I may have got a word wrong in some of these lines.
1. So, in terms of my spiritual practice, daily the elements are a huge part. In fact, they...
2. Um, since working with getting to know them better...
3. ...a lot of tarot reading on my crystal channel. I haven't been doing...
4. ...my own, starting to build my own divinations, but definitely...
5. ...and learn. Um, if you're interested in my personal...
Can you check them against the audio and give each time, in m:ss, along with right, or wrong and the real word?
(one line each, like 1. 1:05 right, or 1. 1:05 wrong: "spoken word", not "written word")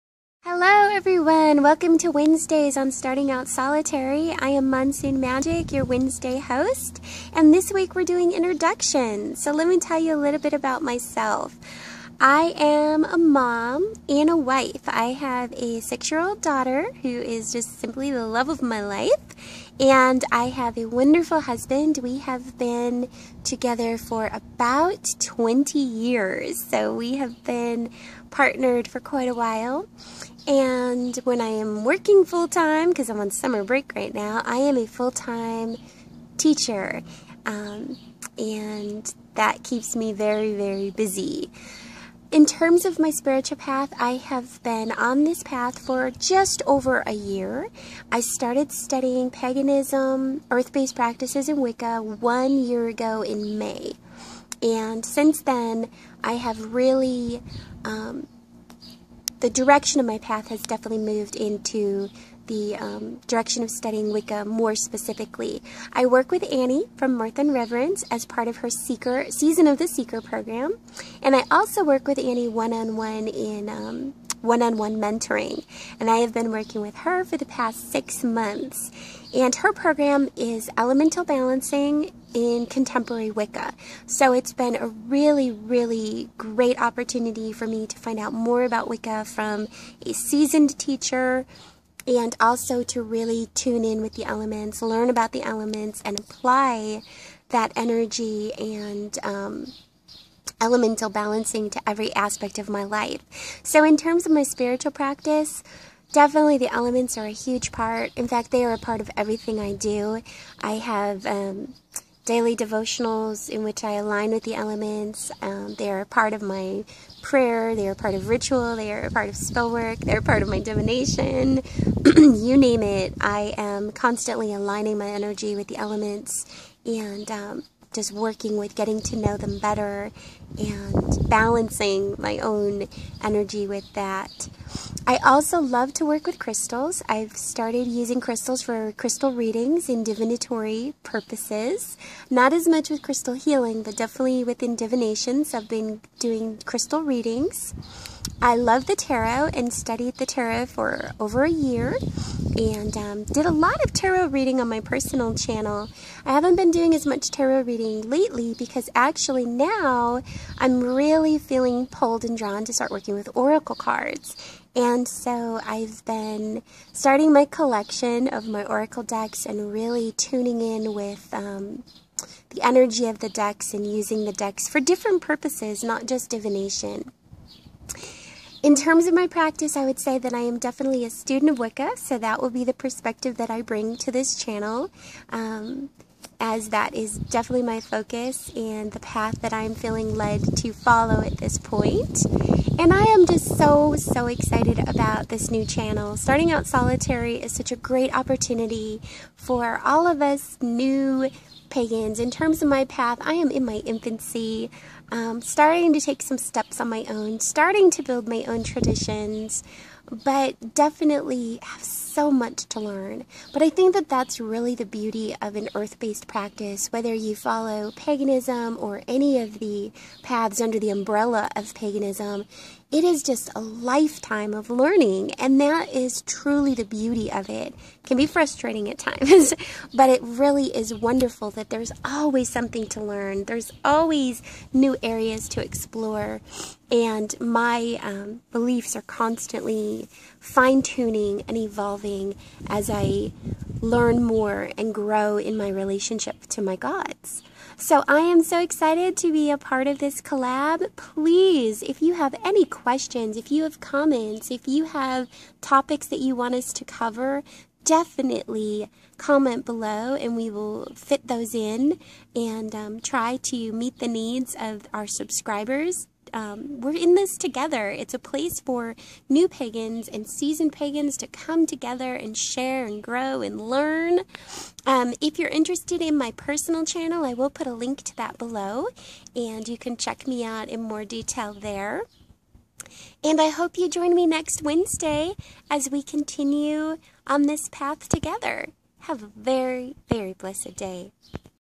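1. 1:43 wrong: "definitely", not "daily"
2. 2:07 wrong: "practice", not "since"
3. 2:33 wrong: "personal", not "crystal"
4. 3:26 wrong: "traditions", not "divinations"
5. 4:33 right.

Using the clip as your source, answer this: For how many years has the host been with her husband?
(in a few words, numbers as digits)
20.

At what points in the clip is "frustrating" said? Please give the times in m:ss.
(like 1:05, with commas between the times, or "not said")
3:48.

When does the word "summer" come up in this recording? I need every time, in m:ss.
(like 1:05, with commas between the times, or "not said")
0:33.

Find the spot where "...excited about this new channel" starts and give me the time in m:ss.
3:14.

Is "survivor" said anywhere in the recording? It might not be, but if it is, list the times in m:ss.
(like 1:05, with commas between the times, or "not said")
not said.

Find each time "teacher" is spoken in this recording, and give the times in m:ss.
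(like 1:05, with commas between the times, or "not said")
0:36, 1:30.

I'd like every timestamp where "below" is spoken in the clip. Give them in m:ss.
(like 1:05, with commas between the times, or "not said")
4:19, 4:38.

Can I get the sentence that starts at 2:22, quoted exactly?
Not as much with crystal healing, but definitely within divinations.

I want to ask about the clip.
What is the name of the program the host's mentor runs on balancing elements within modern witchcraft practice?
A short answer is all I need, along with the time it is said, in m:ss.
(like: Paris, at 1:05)
Elemental Balancing in Contemporary Wicca, at 1:20.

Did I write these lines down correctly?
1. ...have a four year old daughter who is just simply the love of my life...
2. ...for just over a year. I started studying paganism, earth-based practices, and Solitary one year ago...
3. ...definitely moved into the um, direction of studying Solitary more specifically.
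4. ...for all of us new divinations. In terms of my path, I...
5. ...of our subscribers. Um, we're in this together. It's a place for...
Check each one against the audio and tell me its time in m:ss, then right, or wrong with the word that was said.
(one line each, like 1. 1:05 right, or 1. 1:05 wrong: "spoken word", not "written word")
1. 0:15 wrong: "six", not "four"
2. 0:45 wrong: "Wicca", not "Solitary"
3. 1:00 wrong: "Wicca", not "Solitary"
4. 3:19 wrong: "pagans", not "divinations"
5. 4:24 right.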